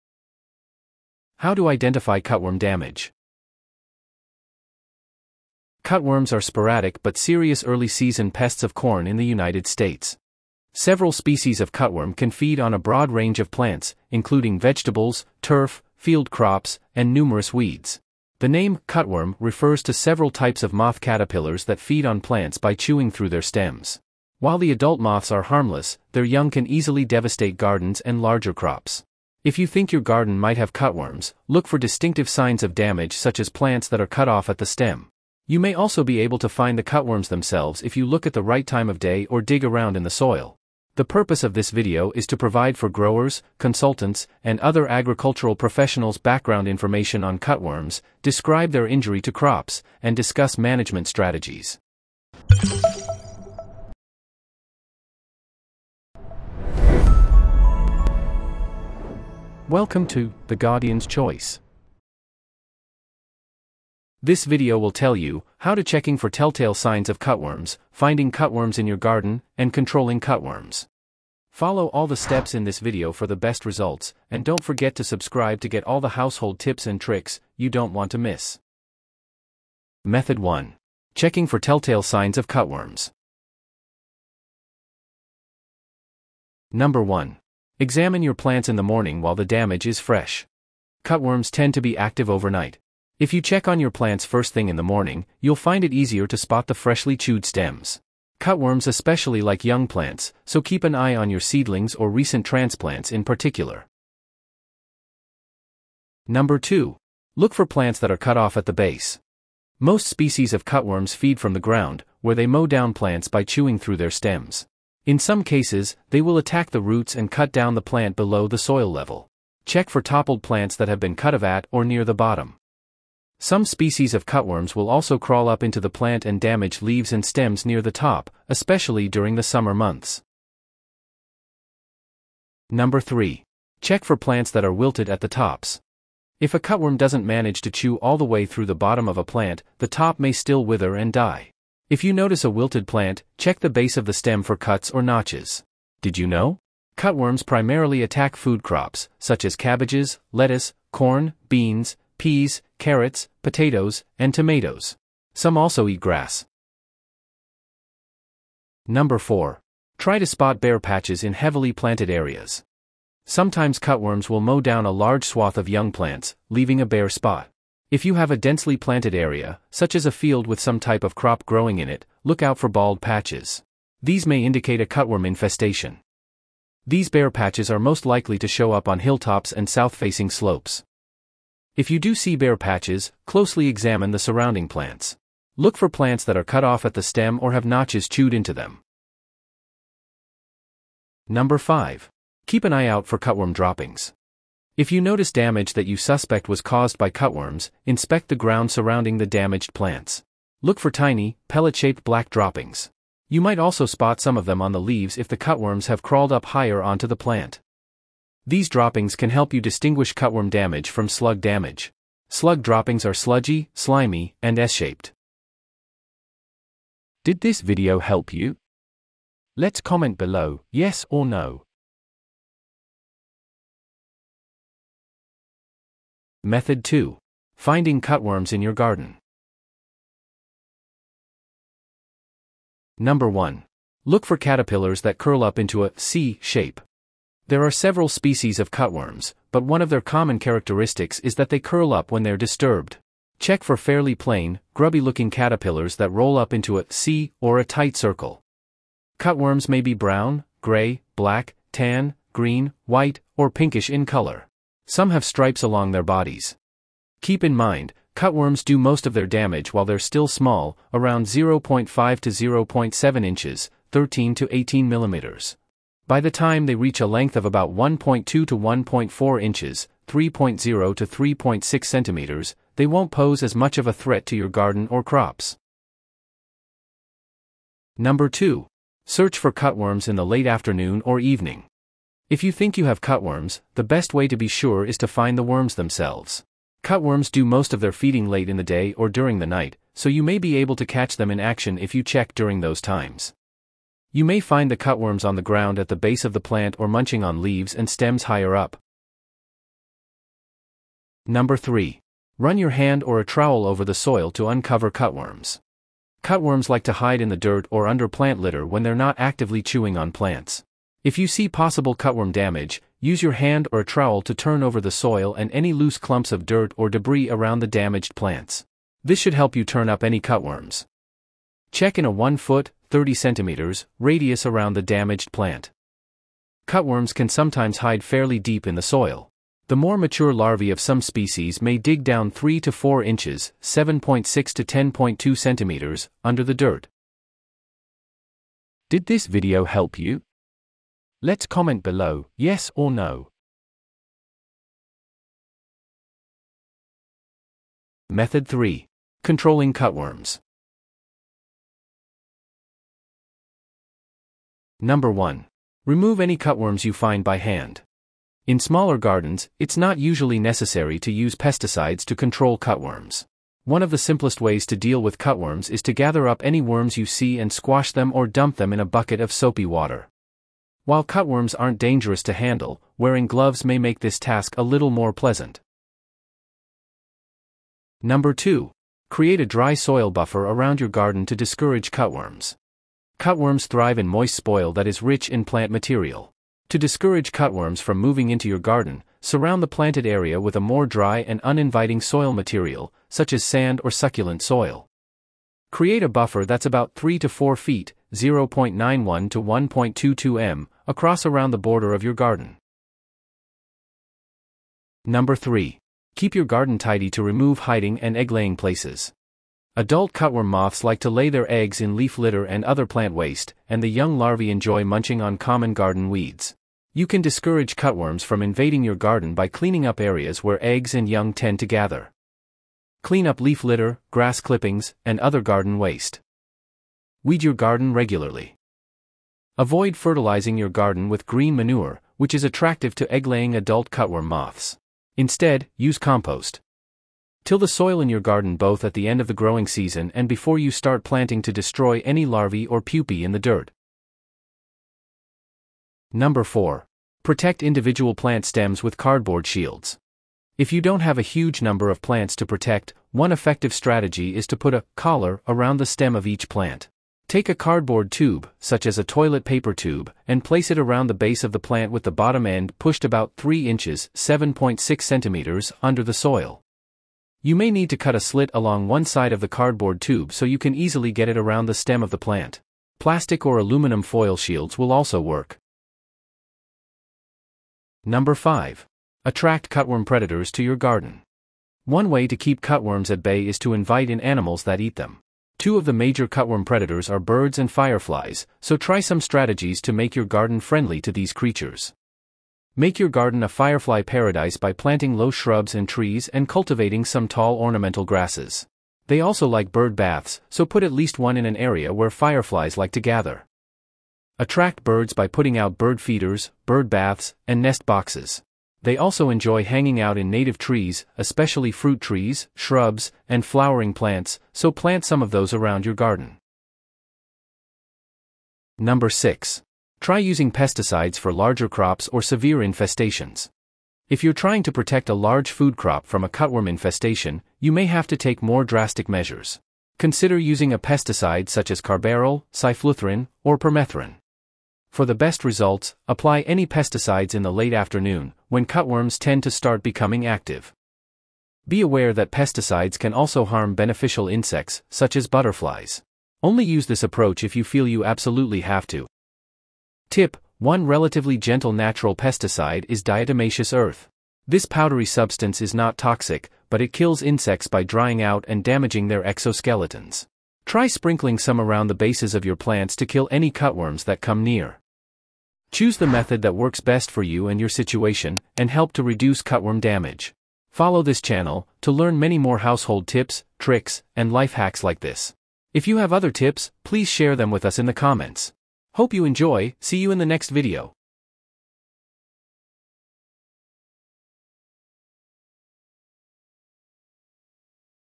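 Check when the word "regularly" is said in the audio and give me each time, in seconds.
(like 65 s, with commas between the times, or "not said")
427 s.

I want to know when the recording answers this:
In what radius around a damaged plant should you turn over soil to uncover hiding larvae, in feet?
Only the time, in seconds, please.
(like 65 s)
322 s.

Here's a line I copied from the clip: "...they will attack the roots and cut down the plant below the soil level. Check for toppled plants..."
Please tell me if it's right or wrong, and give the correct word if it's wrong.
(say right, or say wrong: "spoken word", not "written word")
right.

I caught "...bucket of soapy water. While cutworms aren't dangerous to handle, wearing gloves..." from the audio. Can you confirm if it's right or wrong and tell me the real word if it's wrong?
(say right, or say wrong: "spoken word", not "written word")
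right.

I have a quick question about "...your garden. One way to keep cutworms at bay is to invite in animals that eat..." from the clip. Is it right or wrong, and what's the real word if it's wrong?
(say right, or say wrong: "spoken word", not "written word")
right.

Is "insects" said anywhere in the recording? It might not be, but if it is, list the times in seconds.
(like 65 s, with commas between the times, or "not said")
544 s, 557 s.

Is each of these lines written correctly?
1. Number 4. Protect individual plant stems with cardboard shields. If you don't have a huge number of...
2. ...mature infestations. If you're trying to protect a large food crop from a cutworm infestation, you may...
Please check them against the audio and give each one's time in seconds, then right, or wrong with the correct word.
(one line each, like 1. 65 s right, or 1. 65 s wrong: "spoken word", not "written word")
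1. 446 s right
2. 522 s wrong: "severe", not "mature".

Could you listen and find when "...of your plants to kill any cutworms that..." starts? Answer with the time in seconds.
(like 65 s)
562 s.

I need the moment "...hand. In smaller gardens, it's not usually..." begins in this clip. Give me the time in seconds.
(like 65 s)
357 s.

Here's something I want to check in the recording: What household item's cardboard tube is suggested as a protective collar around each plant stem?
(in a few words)
Toilet paper tube.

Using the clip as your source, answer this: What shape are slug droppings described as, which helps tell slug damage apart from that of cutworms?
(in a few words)
S-shaped.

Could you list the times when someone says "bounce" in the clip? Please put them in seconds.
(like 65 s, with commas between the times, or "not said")
not said.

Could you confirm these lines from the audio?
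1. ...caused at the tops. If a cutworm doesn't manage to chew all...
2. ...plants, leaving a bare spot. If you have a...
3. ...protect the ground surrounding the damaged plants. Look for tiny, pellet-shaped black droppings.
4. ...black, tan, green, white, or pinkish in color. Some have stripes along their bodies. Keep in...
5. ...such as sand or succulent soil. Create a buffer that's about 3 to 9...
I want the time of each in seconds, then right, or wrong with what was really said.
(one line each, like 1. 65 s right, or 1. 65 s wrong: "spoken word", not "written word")
1. 134 s wrong: "wilted", not "caused"
2. 165 s right
3. 197 s wrong: "inspect", not "protect"
4. 251 s right
5. 393 s wrong: "4", not "9".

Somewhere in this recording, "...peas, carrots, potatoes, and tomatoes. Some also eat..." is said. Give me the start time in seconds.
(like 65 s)
152 s.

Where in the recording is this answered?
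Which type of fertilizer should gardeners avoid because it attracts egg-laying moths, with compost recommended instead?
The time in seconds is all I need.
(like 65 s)
431 s.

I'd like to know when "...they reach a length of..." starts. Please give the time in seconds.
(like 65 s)
266 s.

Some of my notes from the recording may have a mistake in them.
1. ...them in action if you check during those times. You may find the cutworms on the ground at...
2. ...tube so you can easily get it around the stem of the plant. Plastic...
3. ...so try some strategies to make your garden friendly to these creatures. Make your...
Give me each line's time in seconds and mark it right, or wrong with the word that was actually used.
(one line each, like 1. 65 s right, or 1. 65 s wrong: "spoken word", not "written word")
1. 291 s right
2. 470 s right
3. 488 s right.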